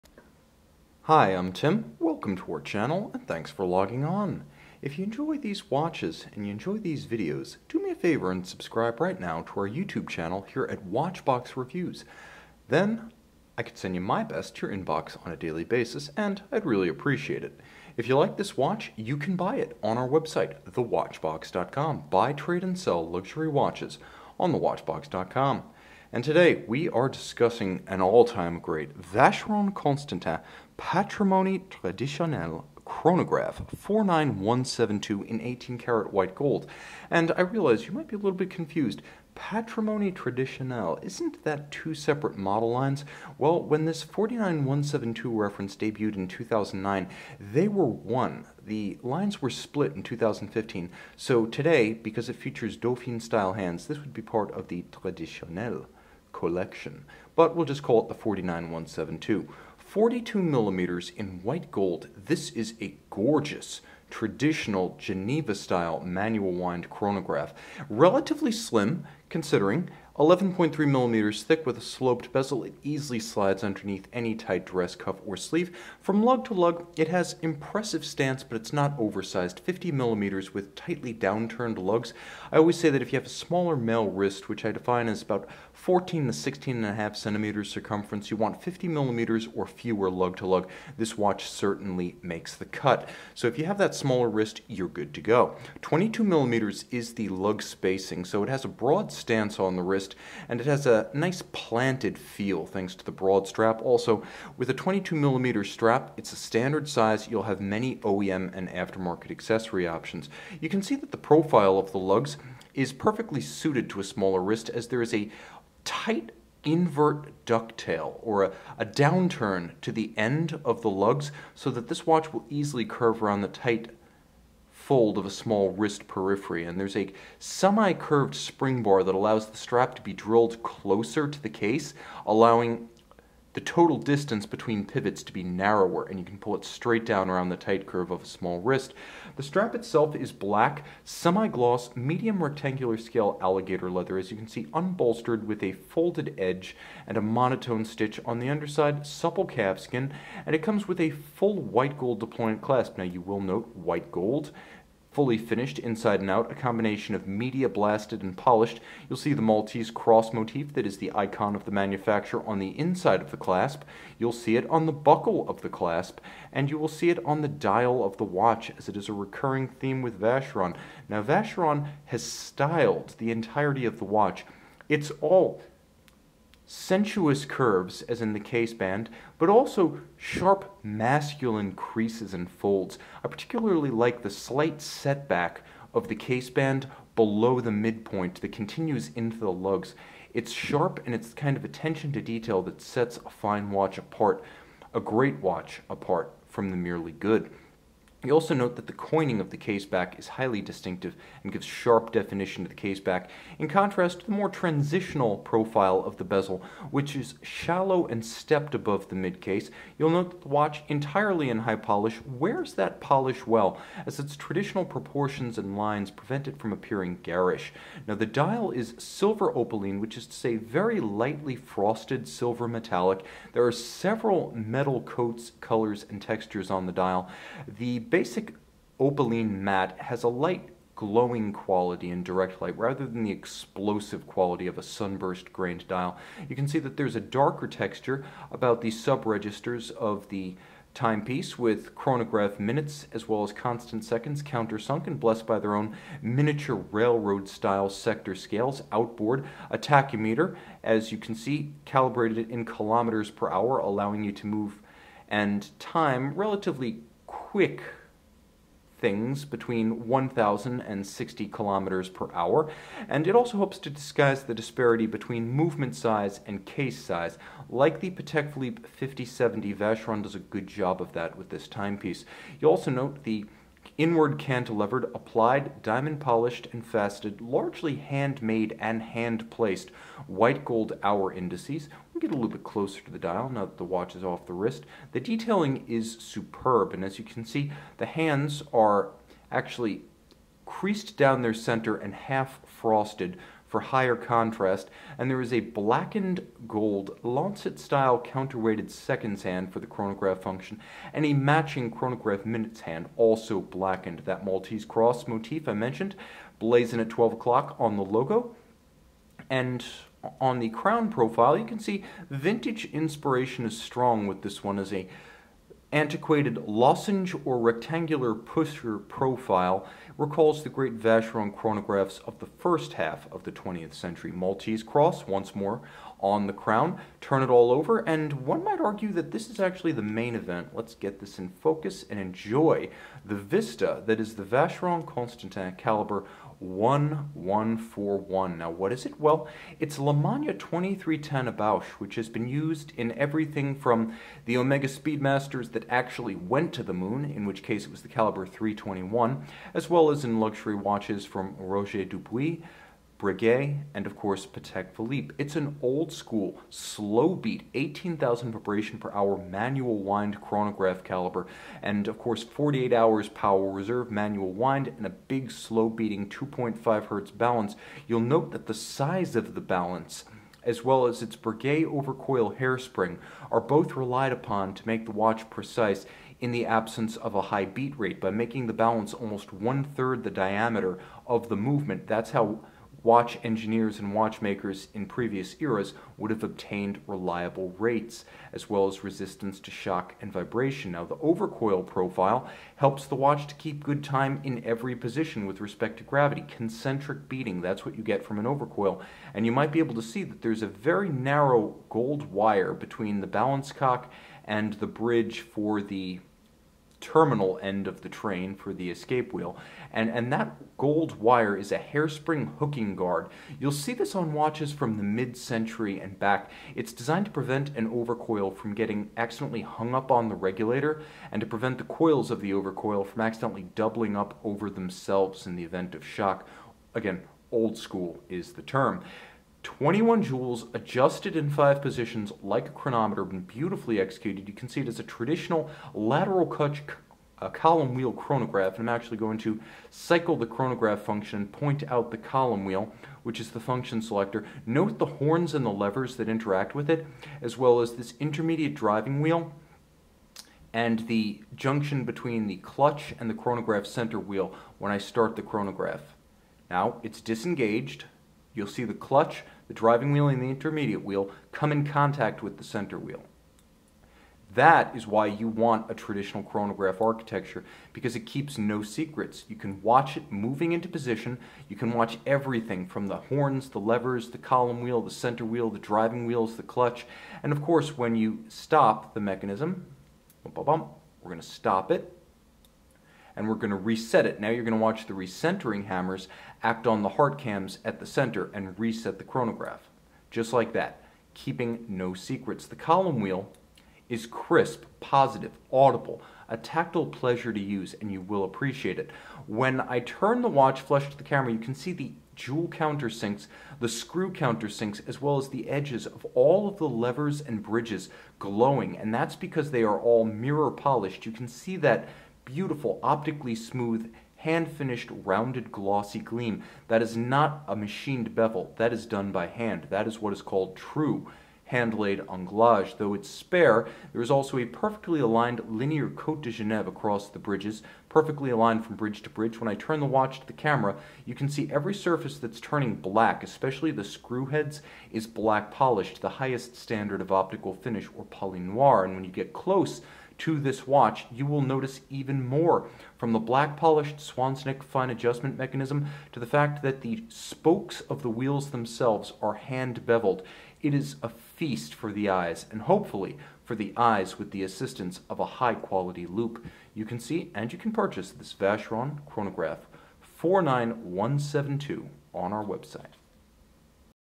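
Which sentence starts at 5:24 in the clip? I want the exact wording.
Maltese cross, once more, on the crown, turn it all over, and one might argue that this is actually the main event.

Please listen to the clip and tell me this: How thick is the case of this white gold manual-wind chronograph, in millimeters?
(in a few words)
11.3 millimeters.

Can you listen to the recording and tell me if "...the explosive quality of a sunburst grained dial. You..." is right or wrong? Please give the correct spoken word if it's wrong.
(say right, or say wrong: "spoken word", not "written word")
right.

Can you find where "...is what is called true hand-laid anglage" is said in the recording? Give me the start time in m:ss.
8:40.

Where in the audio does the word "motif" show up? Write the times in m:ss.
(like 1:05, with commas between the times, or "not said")
2:40, 5:05.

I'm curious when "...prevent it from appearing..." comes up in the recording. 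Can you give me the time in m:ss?
3:36.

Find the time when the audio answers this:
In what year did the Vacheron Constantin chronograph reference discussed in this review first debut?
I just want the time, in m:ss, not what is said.
0:46.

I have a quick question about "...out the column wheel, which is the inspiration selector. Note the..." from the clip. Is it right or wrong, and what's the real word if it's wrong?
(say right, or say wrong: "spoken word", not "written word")
wrong: "function", not "inspiration".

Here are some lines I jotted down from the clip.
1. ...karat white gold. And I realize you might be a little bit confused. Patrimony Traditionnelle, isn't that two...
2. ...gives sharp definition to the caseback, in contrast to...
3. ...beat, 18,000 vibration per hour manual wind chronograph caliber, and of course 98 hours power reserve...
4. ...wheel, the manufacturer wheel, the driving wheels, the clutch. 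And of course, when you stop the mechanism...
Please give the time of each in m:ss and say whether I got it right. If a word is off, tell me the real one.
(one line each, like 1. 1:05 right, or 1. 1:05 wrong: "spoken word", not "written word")
1. 0:35 right
2. 3:21 right
3. 5:57 wrong: "48", not "98"
4. 7:54 wrong: "center", not "manufacturer".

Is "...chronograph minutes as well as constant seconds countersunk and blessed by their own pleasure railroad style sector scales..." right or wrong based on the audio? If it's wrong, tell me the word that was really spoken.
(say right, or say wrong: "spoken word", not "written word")
wrong: "miniature", not "pleasure".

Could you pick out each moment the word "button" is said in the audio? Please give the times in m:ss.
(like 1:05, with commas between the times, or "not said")
not said.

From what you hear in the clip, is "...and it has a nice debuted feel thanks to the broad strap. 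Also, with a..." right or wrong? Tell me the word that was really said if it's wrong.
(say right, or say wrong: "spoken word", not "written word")
wrong: "planted", not "debuted".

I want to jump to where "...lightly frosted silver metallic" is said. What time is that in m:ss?
3:40.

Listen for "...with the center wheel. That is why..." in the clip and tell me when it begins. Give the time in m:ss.
7:42.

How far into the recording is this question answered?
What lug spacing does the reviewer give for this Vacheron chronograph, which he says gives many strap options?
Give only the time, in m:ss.
1:35.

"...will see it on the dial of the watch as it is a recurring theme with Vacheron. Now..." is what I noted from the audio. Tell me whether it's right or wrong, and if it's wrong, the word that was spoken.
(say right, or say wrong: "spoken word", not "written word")
right.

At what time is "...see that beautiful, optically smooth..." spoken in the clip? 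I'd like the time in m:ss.
8:31.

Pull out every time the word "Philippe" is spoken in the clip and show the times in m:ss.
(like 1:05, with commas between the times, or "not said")
4:28, 5:54.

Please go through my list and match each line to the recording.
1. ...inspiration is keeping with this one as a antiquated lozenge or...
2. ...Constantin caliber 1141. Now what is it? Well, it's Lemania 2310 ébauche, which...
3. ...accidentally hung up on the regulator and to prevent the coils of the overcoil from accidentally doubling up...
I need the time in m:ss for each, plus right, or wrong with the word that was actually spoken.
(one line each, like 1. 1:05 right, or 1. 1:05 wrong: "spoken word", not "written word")
1. 5:12 wrong: "strong", not "keeping"
2. 5:35 right
3. 6:59 right.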